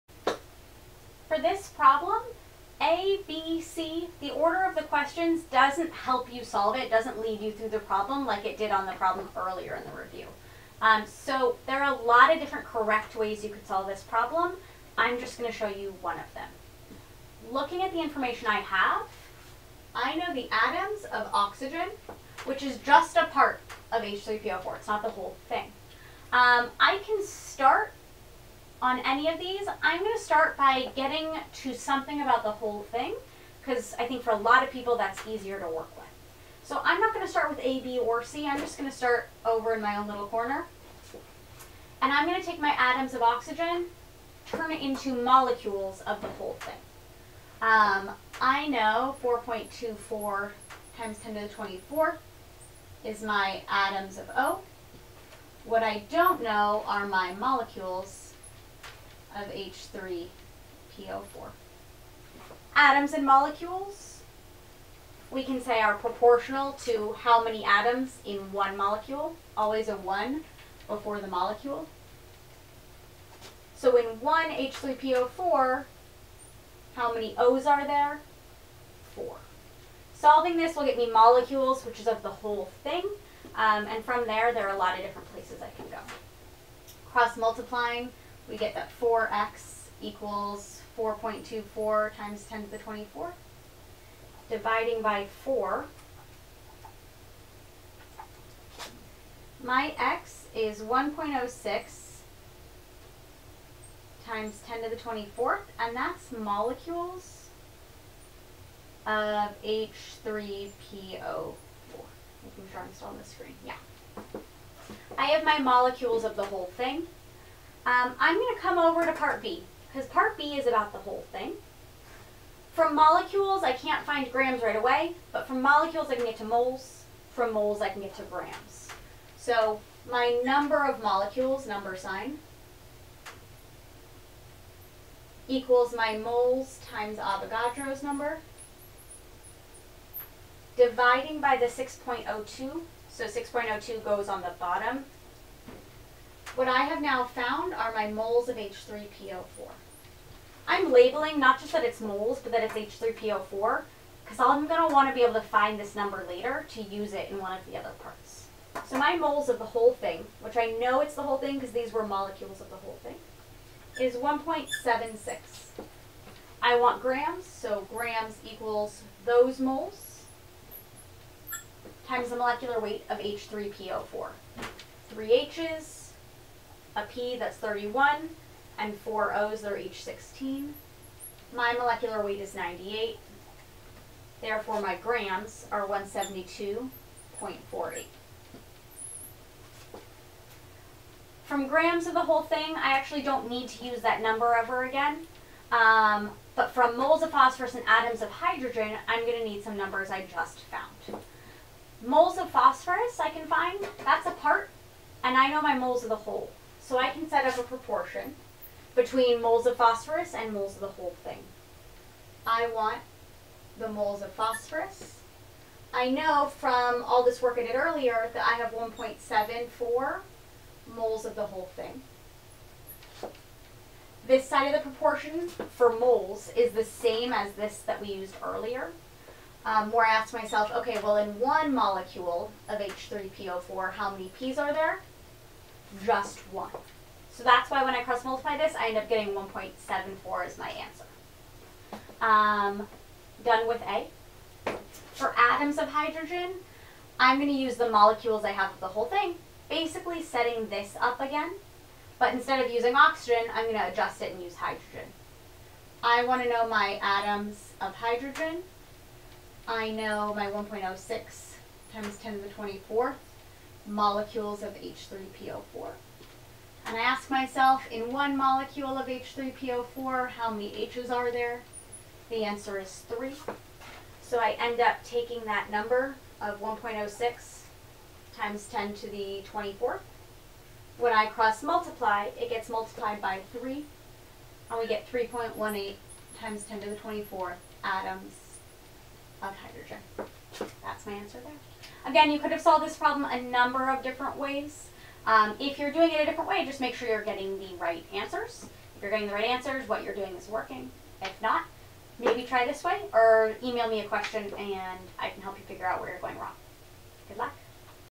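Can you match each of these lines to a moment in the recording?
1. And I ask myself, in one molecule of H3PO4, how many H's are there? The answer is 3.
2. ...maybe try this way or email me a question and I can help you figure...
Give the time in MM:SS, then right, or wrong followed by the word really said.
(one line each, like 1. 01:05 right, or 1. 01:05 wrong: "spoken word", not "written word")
1. 04:26 right
2. 05:02 right.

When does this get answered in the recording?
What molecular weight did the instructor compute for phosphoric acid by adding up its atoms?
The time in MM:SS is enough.
03:02.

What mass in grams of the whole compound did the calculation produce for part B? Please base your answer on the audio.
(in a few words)
172.48.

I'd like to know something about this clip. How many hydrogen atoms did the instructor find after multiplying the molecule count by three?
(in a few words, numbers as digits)
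3.18 x 10^24.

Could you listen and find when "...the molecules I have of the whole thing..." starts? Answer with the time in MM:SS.
04:07.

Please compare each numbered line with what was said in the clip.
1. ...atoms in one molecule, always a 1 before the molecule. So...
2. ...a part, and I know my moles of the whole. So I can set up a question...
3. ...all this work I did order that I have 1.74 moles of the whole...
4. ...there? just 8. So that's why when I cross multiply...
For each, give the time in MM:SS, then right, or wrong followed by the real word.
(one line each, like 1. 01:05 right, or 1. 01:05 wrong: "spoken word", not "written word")
1. 01:07 right
2. 03:24 wrong: "proportion", not "question"
3. 03:37 wrong: "earlier", not "order"
4. 03:54 wrong: "1", not "8".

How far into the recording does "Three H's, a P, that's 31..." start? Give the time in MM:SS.
02:55.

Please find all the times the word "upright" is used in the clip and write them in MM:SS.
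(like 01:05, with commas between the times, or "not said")
not said.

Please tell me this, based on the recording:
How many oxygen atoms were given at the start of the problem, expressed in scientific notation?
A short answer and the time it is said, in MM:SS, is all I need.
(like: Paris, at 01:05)
4.24 x 10^24, at 00:49.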